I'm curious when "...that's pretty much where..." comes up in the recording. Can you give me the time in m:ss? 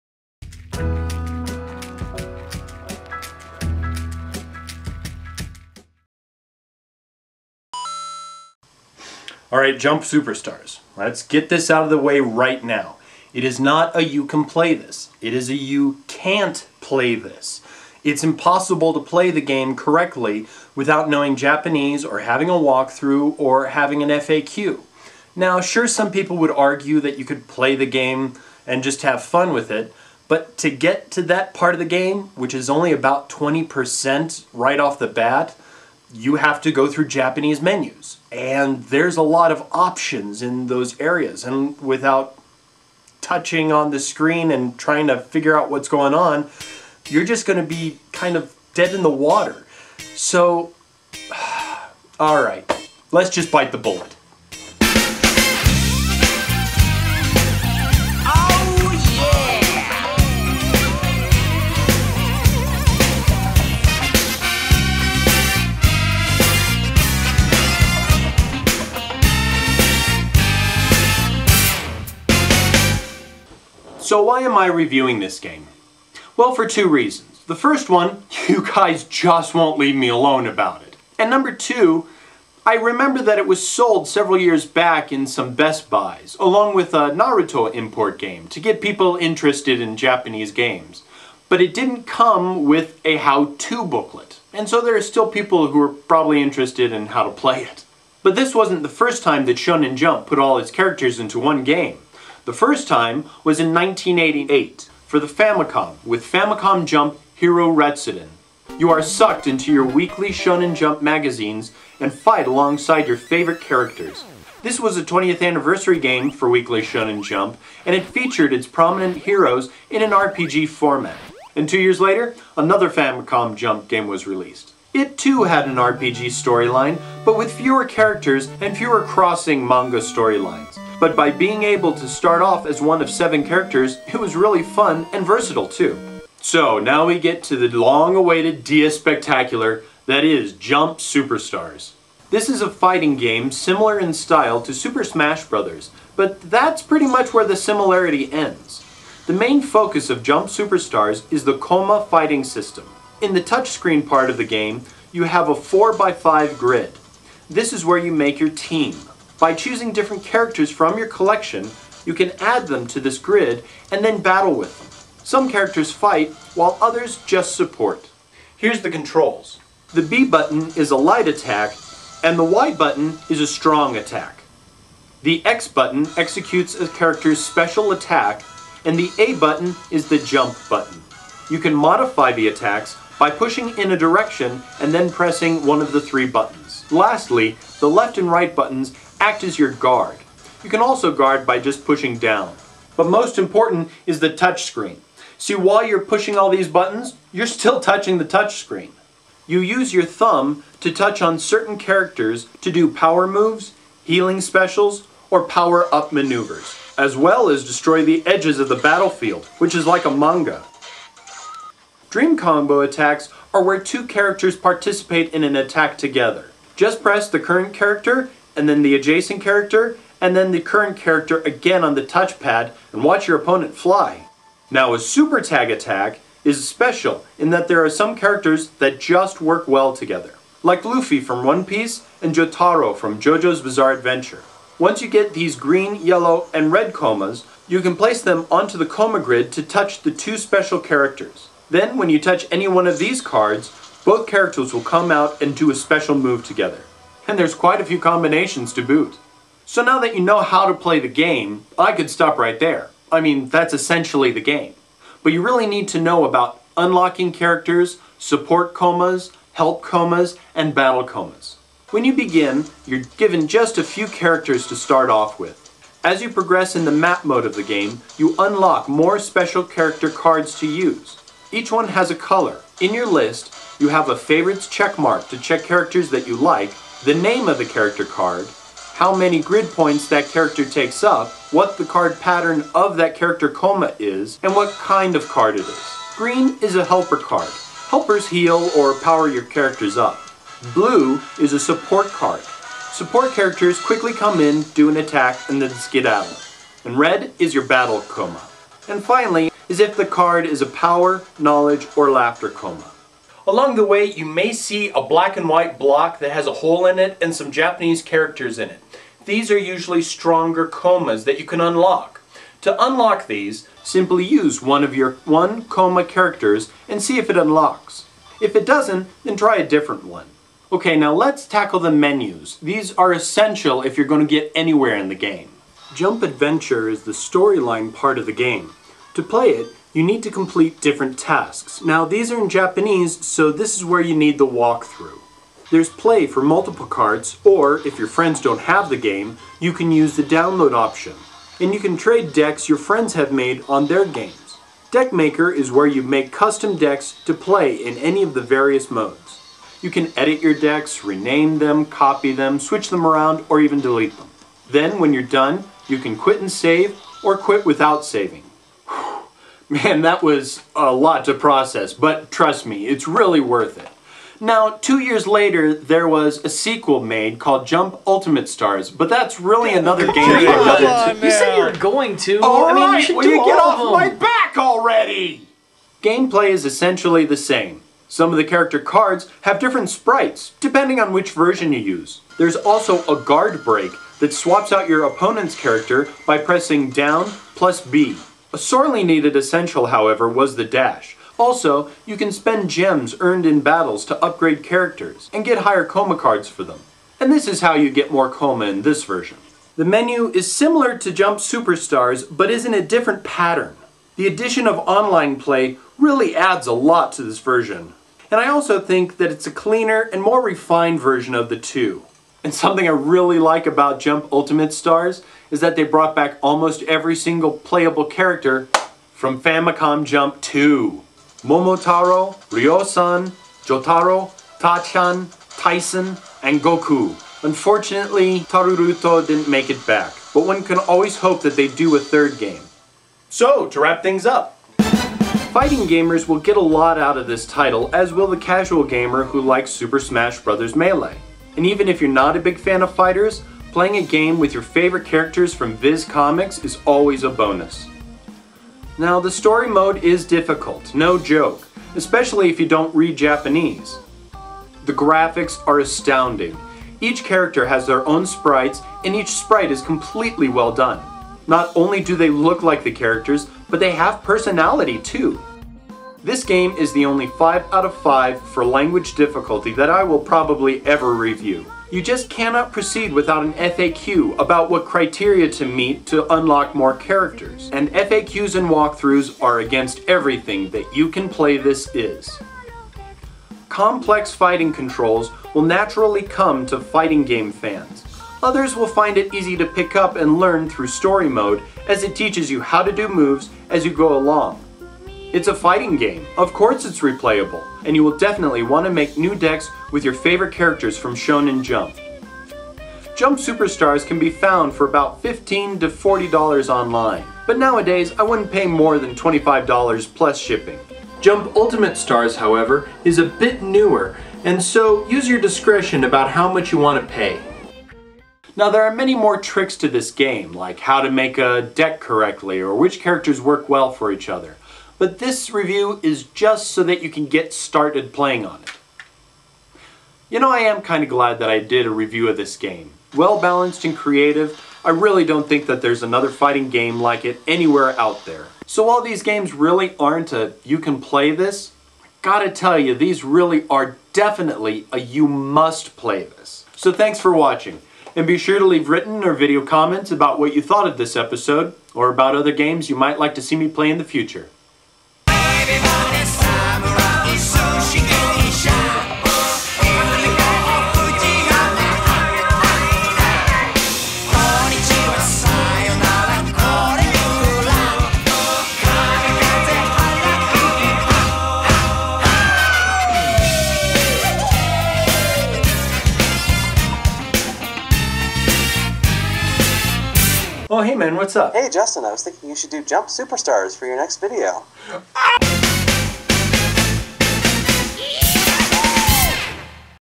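2:26.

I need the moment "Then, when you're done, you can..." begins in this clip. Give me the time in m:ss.
5:54.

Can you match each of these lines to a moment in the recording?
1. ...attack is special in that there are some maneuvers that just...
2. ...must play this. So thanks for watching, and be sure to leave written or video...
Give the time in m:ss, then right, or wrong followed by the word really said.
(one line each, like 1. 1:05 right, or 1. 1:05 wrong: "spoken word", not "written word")
1. 3:45 wrong: "characters", not "maneuvers"
2. 9:05 right.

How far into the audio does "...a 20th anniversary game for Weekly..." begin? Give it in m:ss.
1:54.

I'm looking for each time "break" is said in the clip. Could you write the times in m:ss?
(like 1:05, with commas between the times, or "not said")
6:23.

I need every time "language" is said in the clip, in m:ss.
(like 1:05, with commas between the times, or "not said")
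7:48.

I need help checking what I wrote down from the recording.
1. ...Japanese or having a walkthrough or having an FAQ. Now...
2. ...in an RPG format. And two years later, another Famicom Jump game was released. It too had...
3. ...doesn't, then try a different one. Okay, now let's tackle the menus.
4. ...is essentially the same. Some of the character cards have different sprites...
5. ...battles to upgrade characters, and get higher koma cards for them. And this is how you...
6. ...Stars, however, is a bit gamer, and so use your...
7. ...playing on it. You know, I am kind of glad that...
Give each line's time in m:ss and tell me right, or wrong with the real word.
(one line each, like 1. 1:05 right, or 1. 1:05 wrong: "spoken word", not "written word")
1. 0:21 right
2. 1:59 right
3. 5:18 right
4. 6:16 right
5. 6:33 right
6. 8:31 wrong: "newer", not "gamer"
7. 8:48 right.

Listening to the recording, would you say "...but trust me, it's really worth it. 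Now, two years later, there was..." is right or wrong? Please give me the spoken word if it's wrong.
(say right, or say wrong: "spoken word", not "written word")
right.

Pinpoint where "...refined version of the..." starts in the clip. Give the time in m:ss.
6:50.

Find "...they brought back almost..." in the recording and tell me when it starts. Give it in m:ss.
6:55.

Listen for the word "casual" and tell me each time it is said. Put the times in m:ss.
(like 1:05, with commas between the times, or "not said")
7:18.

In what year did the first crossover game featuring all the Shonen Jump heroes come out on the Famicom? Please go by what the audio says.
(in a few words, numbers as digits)
1988.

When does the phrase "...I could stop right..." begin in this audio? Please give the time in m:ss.
4:11.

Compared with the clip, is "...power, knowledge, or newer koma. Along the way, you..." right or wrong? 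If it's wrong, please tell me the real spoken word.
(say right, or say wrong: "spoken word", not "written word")
wrong: "laughter", not "newer".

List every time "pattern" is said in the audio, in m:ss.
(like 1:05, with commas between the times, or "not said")
4:42, 6:43.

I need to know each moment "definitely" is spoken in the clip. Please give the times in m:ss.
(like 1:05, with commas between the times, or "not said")
8:18, 9:04.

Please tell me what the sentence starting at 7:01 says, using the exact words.
Momotaro, Ryosan, Jotaro, Tachan, Tyson, and Goku.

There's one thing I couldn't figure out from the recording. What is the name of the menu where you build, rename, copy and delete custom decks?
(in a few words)
Deck Maker.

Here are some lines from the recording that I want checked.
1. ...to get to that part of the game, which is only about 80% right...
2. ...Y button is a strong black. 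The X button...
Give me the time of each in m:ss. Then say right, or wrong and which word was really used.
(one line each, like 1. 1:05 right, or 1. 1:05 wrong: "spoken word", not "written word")
1. 0:30 wrong: "20", not "80"
2. 2:52 wrong: "attack", not "black".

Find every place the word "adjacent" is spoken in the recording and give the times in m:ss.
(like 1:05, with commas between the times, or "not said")
3:38.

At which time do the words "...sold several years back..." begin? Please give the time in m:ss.
1:23.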